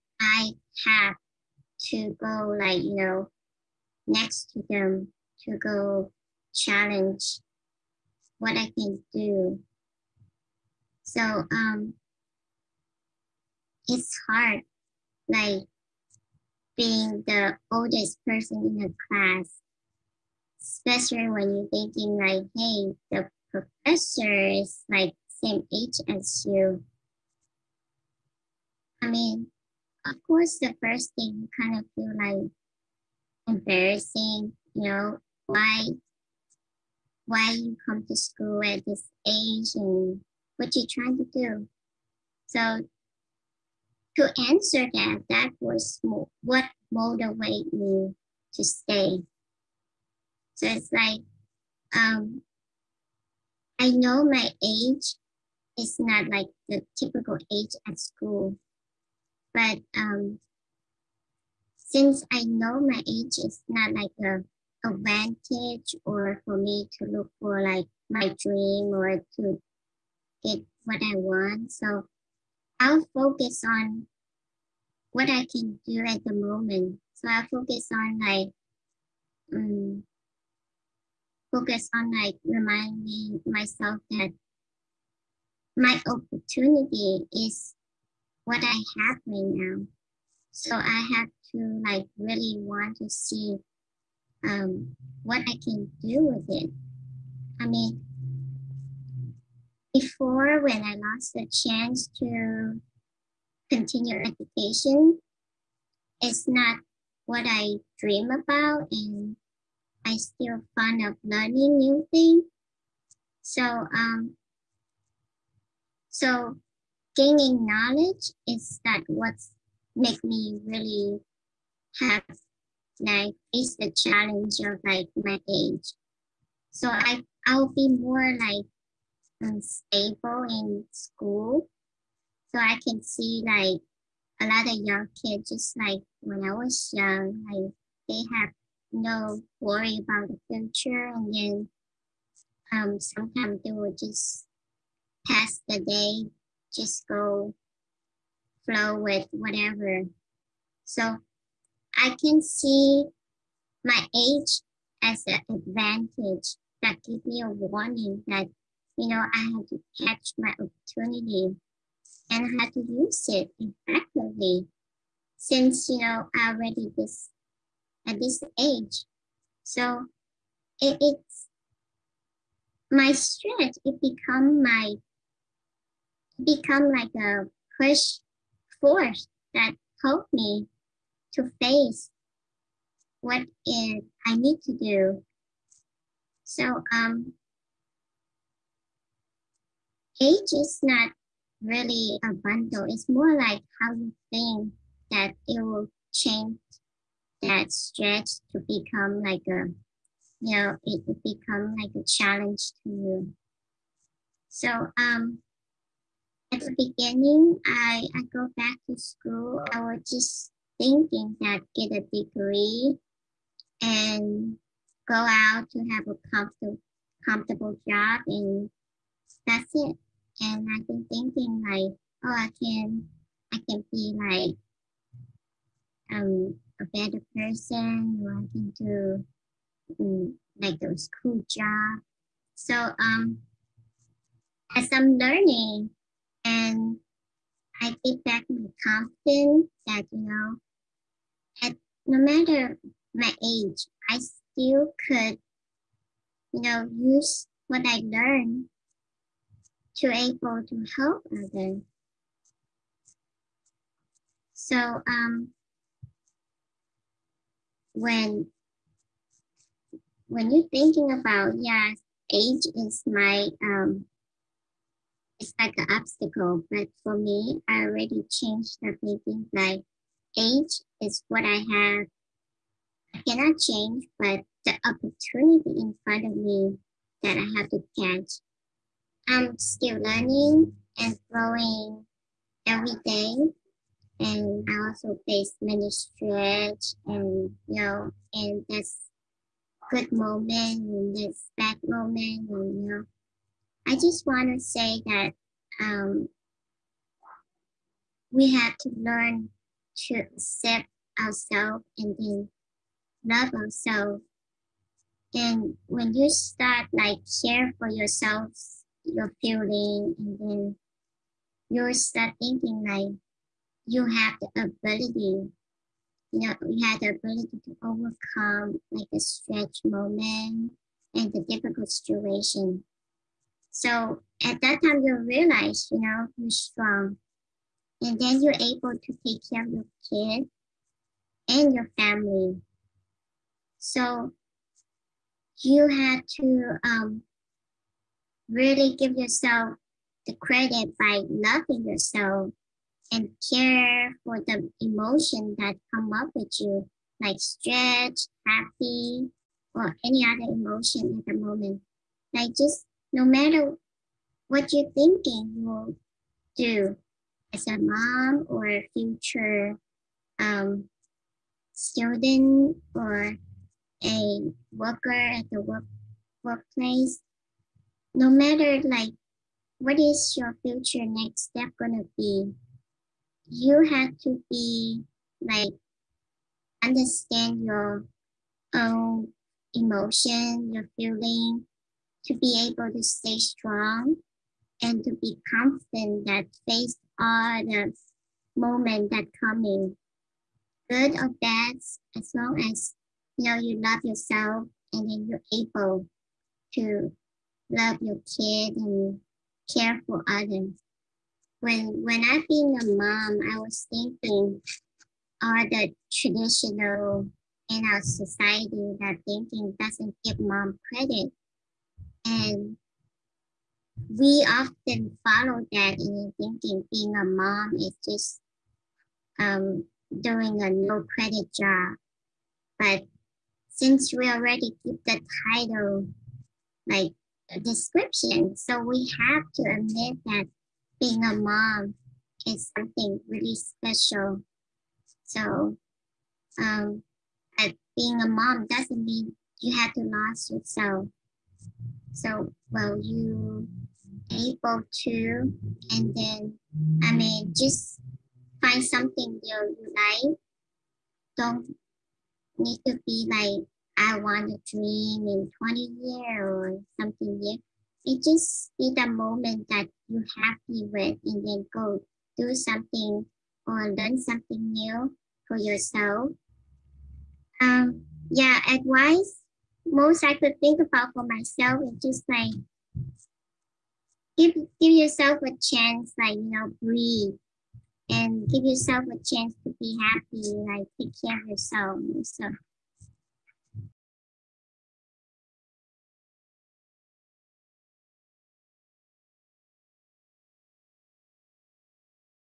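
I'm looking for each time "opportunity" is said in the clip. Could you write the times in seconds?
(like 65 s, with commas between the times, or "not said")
86 s, 160 s, 274 s.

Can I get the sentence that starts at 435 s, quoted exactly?
So, um, but being a mom doesn't mean you have to lose yourself.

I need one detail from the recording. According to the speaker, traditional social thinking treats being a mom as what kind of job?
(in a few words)
a no credit job.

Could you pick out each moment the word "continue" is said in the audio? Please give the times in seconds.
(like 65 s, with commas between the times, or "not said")
103 s.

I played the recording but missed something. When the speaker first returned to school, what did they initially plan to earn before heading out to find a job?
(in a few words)
a degree.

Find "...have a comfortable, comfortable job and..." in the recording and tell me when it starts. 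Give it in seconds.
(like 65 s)
215 s.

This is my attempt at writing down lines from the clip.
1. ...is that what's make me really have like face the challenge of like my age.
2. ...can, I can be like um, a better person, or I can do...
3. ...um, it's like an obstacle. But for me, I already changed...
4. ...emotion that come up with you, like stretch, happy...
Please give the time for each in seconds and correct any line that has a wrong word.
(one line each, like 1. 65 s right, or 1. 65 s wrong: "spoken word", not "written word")
1. 118 s right
2. 222 s right
3. 263 s right
4. 344 s right.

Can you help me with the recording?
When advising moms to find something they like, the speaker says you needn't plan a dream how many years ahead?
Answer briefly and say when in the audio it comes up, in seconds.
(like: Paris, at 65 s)
20, at 455 s.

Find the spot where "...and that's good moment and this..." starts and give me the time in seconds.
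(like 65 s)
288 s.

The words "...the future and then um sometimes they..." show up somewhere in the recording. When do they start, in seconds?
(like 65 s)
140 s.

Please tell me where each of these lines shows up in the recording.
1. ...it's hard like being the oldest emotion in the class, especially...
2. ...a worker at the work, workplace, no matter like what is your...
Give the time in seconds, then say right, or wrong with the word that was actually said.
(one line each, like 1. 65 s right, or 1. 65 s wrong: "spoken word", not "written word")
1. 13 s wrong: "person", not "emotion"
2. 364 s right.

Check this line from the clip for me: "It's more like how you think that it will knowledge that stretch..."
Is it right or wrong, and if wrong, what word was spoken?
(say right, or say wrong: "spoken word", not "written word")
wrong: "change", not "knowledge".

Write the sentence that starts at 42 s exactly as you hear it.
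So to answer that, that was what motivated me to stay.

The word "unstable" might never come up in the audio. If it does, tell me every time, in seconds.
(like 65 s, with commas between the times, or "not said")
129 s.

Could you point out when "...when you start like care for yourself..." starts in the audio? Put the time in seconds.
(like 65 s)
305 s.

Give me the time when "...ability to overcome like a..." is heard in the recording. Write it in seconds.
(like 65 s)
317 s.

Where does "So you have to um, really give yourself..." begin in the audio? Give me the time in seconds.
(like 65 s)
333 s.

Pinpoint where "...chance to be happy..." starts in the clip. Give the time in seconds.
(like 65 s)
479 s.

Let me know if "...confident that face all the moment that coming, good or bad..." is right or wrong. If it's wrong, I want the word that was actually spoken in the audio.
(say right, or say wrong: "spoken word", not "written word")
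right.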